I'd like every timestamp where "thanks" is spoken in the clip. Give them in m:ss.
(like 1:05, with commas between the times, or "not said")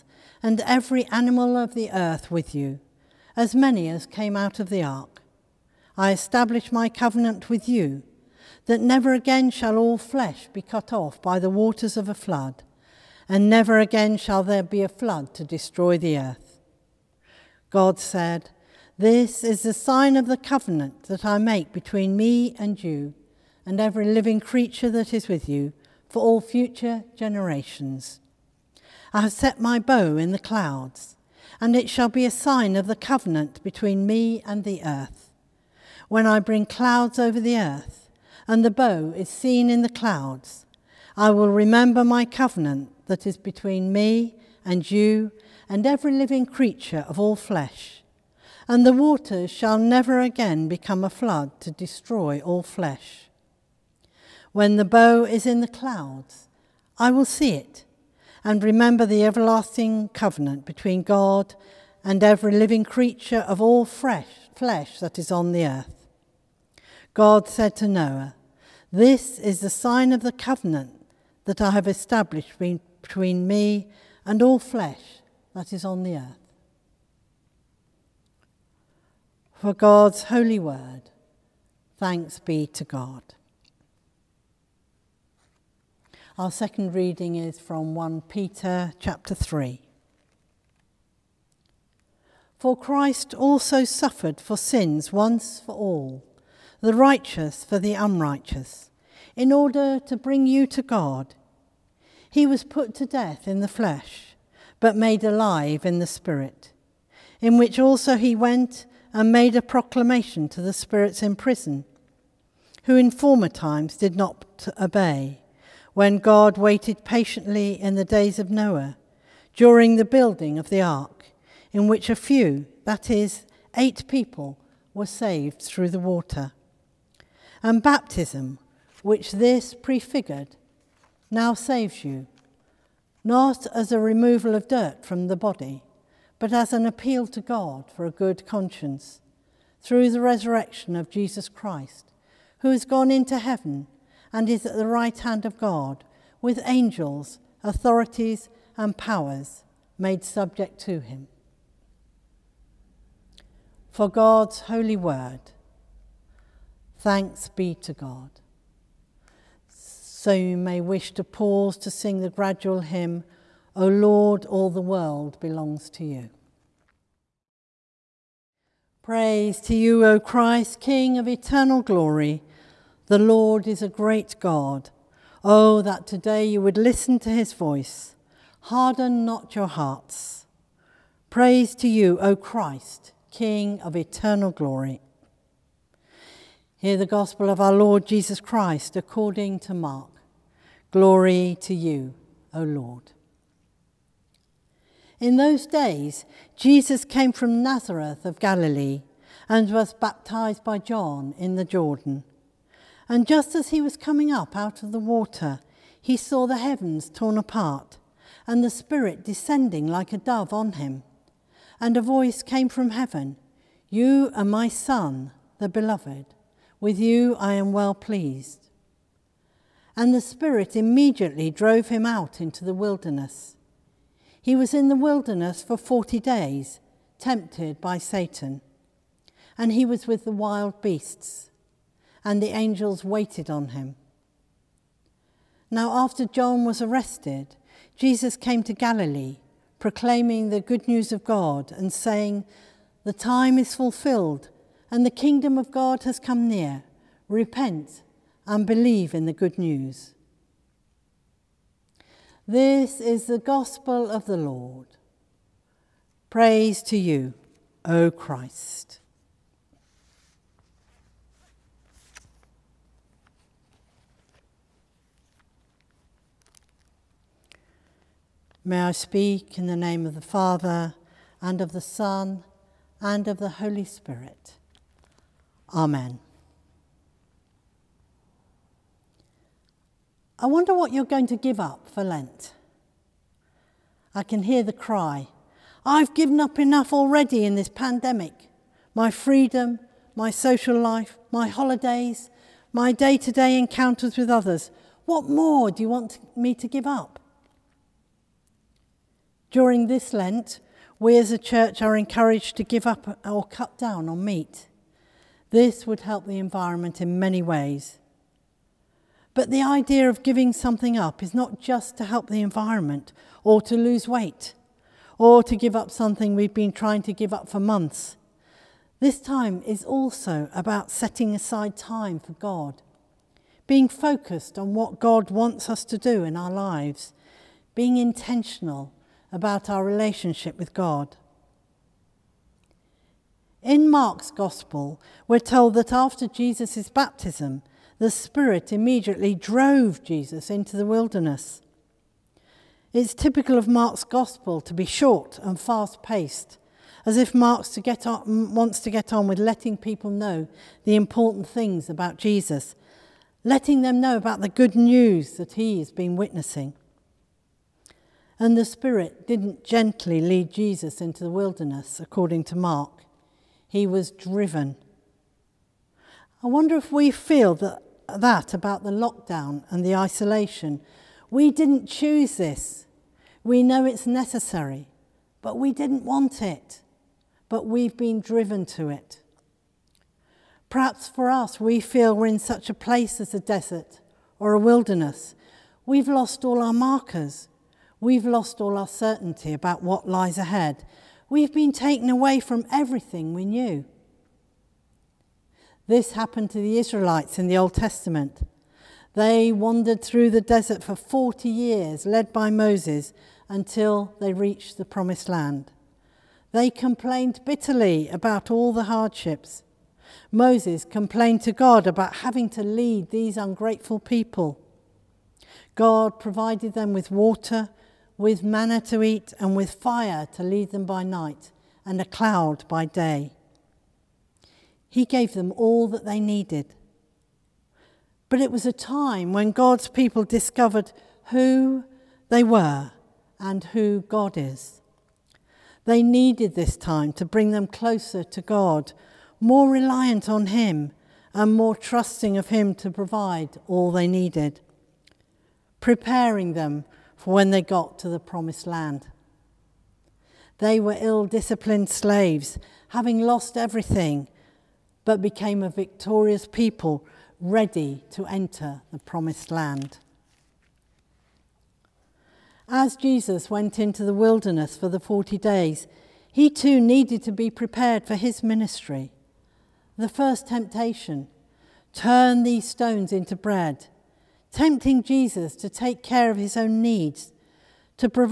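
1:21, 2:36.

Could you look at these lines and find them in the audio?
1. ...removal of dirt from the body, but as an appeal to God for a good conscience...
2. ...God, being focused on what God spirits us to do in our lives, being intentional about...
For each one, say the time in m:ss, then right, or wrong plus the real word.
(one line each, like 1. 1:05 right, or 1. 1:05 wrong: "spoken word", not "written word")
1. 2:13 right
2. 5:22 wrong: "wants", not "spirits".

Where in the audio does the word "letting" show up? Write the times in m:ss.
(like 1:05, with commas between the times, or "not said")
5:49, 5:53.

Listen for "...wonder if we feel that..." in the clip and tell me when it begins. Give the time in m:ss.
6:06.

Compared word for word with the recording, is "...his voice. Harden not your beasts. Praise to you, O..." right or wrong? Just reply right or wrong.
wrong.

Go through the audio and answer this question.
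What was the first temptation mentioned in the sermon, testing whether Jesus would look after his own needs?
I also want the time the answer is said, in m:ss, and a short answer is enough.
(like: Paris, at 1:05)
Turn these stones into bread, at 7:51.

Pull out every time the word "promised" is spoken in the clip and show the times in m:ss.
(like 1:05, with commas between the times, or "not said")
6:44, 7:28, 7:38.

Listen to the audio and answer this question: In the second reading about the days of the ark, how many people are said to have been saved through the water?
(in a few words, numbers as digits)
8.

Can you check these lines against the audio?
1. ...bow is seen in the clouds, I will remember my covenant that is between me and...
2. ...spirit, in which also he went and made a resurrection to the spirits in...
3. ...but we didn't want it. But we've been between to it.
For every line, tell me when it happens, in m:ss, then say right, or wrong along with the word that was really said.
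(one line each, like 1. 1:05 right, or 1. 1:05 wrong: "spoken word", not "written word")
1. 0:38 right
2. 1:46 wrong: "proclamation", not "resurrection"
3. 6:15 wrong: "driven", not "between".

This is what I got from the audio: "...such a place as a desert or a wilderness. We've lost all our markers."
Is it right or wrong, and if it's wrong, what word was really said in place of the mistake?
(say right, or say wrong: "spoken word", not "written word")
right.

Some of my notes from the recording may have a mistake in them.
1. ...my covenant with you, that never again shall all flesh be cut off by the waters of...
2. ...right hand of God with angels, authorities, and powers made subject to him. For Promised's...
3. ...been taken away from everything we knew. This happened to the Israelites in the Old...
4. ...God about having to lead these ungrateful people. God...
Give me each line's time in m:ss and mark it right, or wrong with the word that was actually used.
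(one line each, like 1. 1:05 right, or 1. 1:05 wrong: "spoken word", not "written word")
1. 0:06 right
2. 2:24 wrong: "God", not "Promised"
3. 6:31 right
4. 6:51 right.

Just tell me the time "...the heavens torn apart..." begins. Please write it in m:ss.
3:26.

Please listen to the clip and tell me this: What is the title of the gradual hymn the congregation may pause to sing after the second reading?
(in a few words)
O Lord, all the world belongs to you.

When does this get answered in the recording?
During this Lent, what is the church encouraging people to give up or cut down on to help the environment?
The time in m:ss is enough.
5:04.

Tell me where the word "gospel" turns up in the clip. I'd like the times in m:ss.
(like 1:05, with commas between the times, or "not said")
3:07, 4:13, 5:34, 5:44.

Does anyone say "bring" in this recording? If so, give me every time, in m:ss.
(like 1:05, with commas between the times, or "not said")
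0:36, 1:40, 7:17.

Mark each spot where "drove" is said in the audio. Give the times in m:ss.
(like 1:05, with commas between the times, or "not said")
3:41, 5:39.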